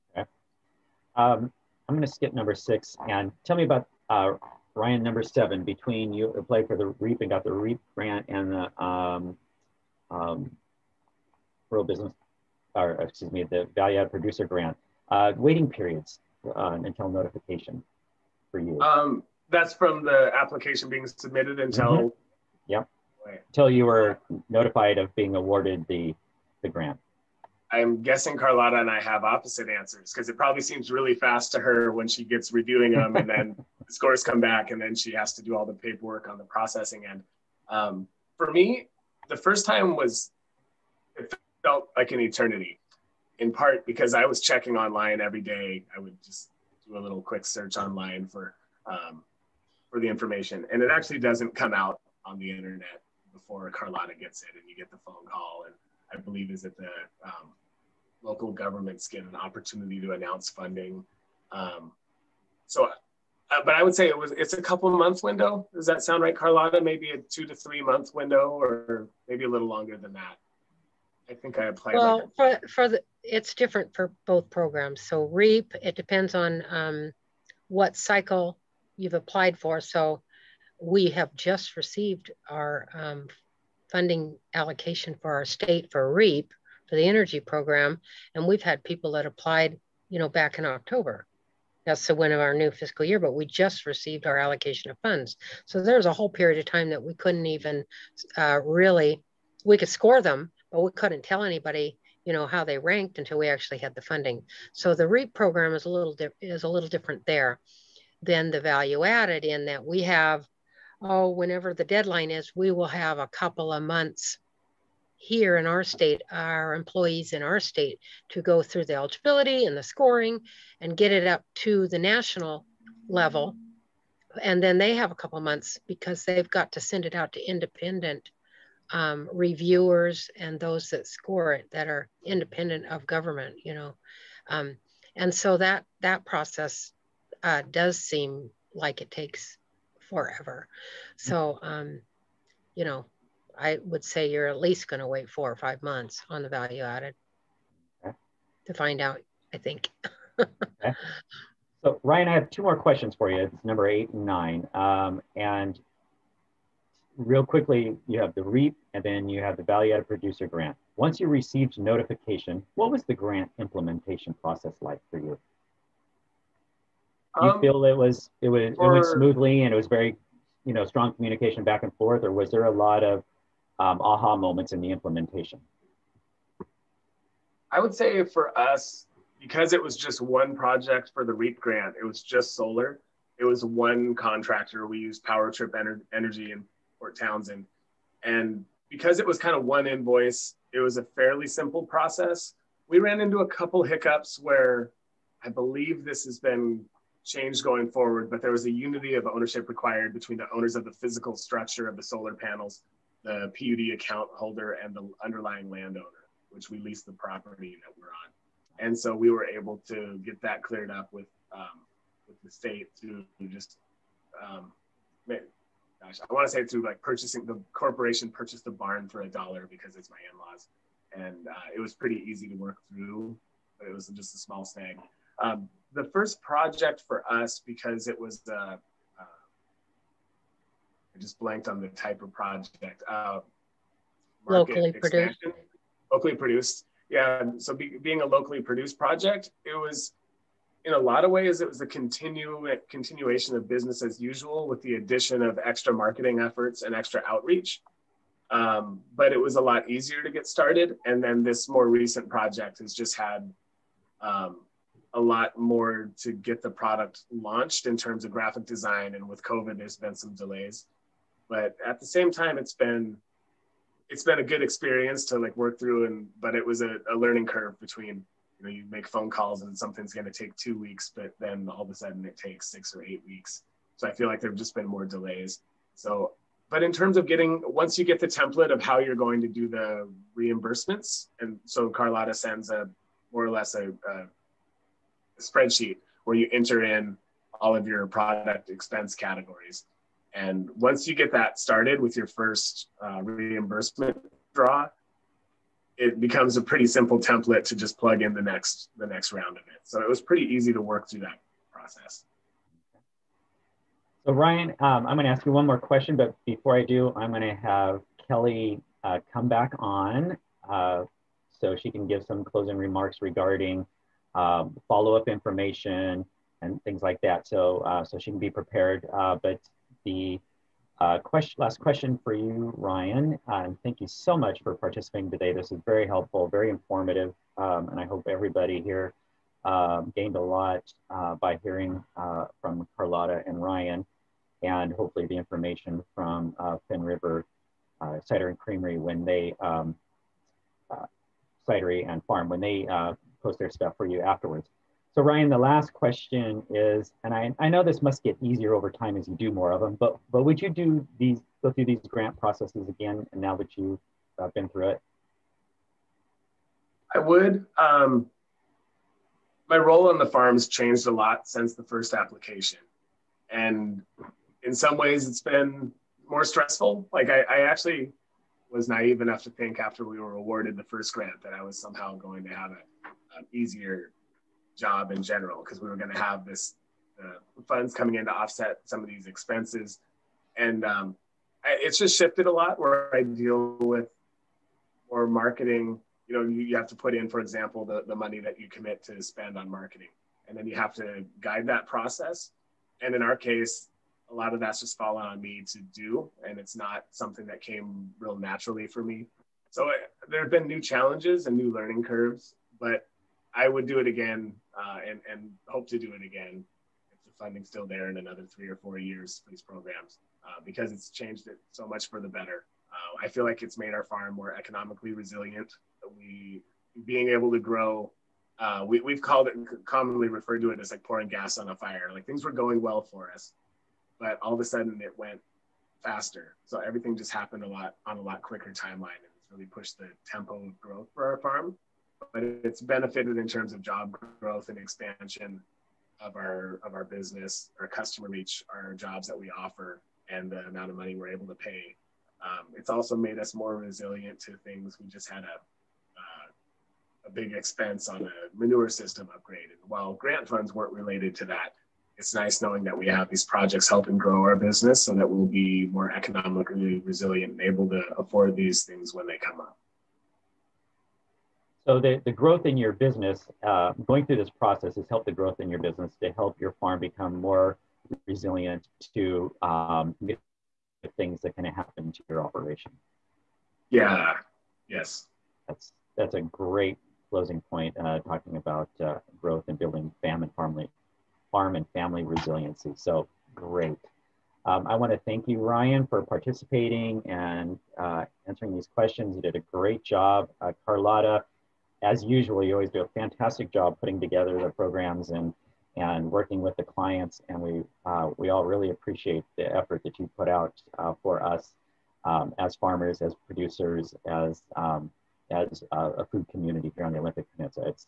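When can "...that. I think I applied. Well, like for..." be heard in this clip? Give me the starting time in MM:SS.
01:10.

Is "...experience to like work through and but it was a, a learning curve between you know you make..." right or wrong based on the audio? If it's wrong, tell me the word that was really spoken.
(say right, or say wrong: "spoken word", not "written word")
right.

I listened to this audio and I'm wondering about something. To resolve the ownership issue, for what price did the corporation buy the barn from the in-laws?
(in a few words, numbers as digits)
1 dollar.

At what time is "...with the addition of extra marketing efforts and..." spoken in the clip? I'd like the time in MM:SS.
04:04.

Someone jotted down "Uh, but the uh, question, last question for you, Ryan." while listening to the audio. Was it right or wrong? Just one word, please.
right.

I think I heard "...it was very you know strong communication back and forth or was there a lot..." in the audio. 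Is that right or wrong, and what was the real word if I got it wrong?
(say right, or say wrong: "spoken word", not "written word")
right.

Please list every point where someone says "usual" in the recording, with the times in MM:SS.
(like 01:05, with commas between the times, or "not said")
04:04, 08:12.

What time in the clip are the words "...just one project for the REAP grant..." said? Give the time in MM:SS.
02:59.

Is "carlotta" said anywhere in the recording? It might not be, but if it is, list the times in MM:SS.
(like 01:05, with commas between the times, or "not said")
00:28, 00:53, 01:06, 04:41, 05:32, 08:10.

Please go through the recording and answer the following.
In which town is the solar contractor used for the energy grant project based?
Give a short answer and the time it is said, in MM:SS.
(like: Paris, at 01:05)
Port Townsend, at 03:06.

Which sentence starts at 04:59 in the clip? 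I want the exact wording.
So it was pretty easy to work through that process.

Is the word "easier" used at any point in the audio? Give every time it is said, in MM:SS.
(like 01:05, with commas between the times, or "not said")
04:09, 05:48, 06:13.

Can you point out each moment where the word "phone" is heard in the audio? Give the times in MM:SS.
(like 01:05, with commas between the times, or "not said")
00:55, 04:29.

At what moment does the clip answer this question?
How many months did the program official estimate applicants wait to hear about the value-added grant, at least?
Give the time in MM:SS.
02:25.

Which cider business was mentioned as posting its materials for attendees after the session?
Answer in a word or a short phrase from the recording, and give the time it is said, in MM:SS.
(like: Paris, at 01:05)
Finnriver, at 05:36.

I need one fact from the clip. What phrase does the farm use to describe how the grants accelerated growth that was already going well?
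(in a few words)
Pouring gas on a fire.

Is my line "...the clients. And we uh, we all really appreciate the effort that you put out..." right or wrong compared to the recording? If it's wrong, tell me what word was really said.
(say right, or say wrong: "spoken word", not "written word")
right.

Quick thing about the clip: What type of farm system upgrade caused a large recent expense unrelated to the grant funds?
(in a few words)
Manure system.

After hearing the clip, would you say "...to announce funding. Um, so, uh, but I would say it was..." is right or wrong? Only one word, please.
right.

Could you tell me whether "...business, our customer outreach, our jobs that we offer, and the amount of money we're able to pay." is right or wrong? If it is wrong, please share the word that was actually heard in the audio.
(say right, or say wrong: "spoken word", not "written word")
wrong: "reach", not "outreach".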